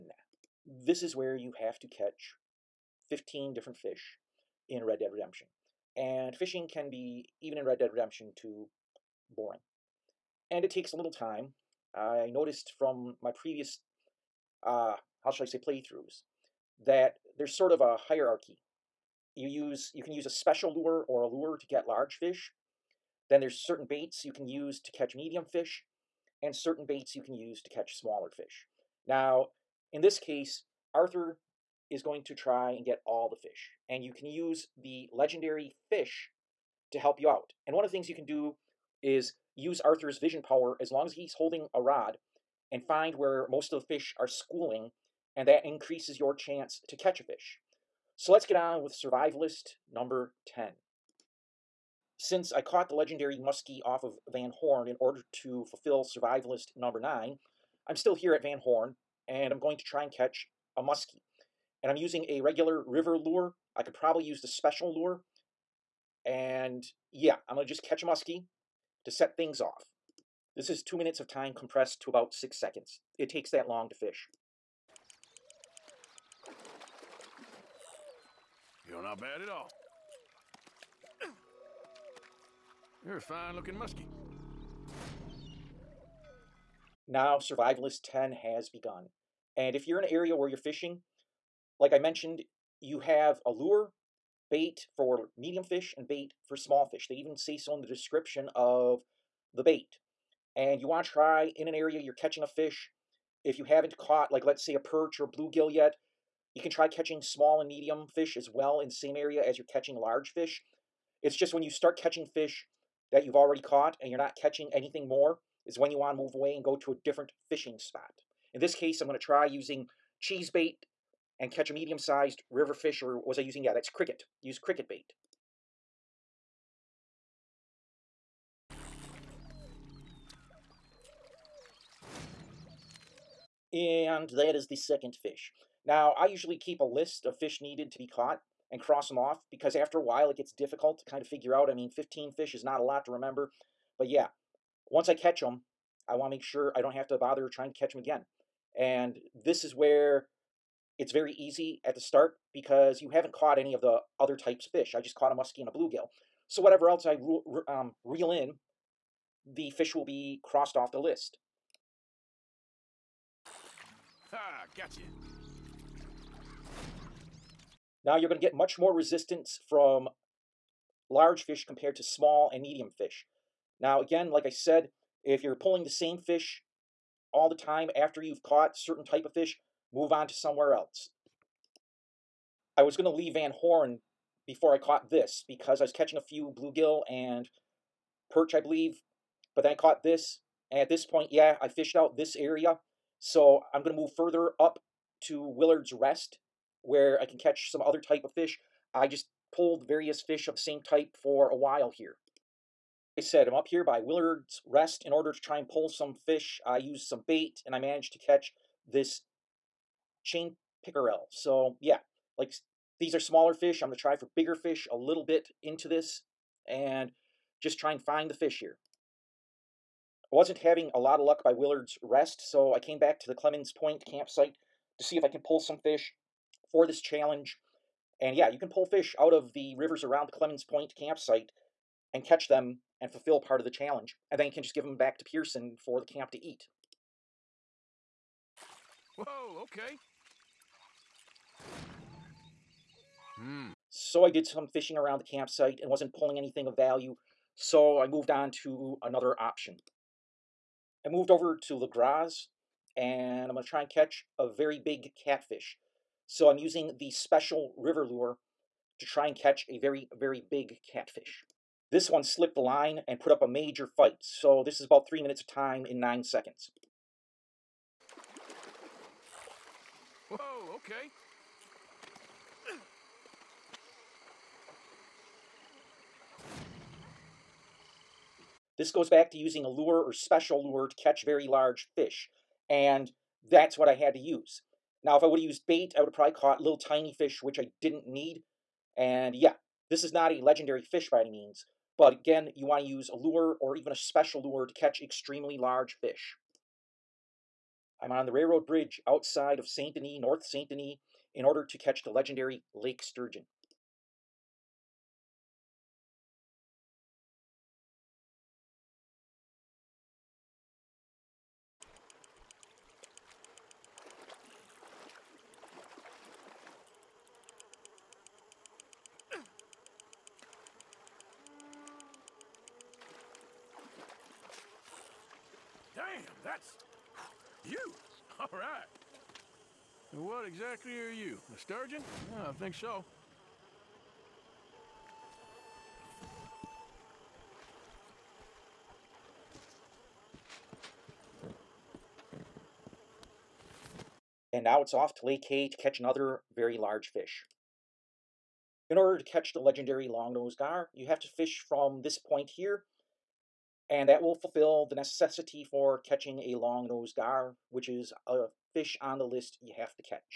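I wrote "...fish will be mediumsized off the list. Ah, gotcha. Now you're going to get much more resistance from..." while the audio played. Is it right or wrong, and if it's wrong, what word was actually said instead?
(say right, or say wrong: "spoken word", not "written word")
wrong: "crossed", not "mediumsized".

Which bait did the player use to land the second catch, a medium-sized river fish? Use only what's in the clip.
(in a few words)
cricket bait.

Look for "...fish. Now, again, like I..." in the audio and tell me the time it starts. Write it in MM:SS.
02:52.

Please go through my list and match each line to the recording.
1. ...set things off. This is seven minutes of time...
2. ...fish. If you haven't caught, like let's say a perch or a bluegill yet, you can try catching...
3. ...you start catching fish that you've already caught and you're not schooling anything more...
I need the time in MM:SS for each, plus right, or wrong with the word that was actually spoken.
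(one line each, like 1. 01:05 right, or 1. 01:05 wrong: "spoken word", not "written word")
1. 01:09 wrong: "two", not "seven"
2. 01:42 right
3. 01:51 wrong: "catching", not "schooling".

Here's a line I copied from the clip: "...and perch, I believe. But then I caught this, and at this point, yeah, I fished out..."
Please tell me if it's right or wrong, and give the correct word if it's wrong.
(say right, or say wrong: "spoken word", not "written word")
right.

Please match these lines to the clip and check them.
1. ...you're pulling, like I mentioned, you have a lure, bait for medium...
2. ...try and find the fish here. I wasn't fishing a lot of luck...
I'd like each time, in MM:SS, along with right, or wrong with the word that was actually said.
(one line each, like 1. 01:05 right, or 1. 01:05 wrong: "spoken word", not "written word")
1. 01:30 wrong: "fishing", not "pulling"
2. 03:37 wrong: "having", not "fishing".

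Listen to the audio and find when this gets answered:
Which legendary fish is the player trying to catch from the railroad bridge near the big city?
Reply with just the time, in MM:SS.
05:02.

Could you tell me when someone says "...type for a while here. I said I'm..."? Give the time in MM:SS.
03:20.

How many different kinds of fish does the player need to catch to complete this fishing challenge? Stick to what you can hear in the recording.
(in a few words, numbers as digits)
15.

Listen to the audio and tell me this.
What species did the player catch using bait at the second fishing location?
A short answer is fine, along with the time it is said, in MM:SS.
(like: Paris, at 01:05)
chain pickerel, at 03:30.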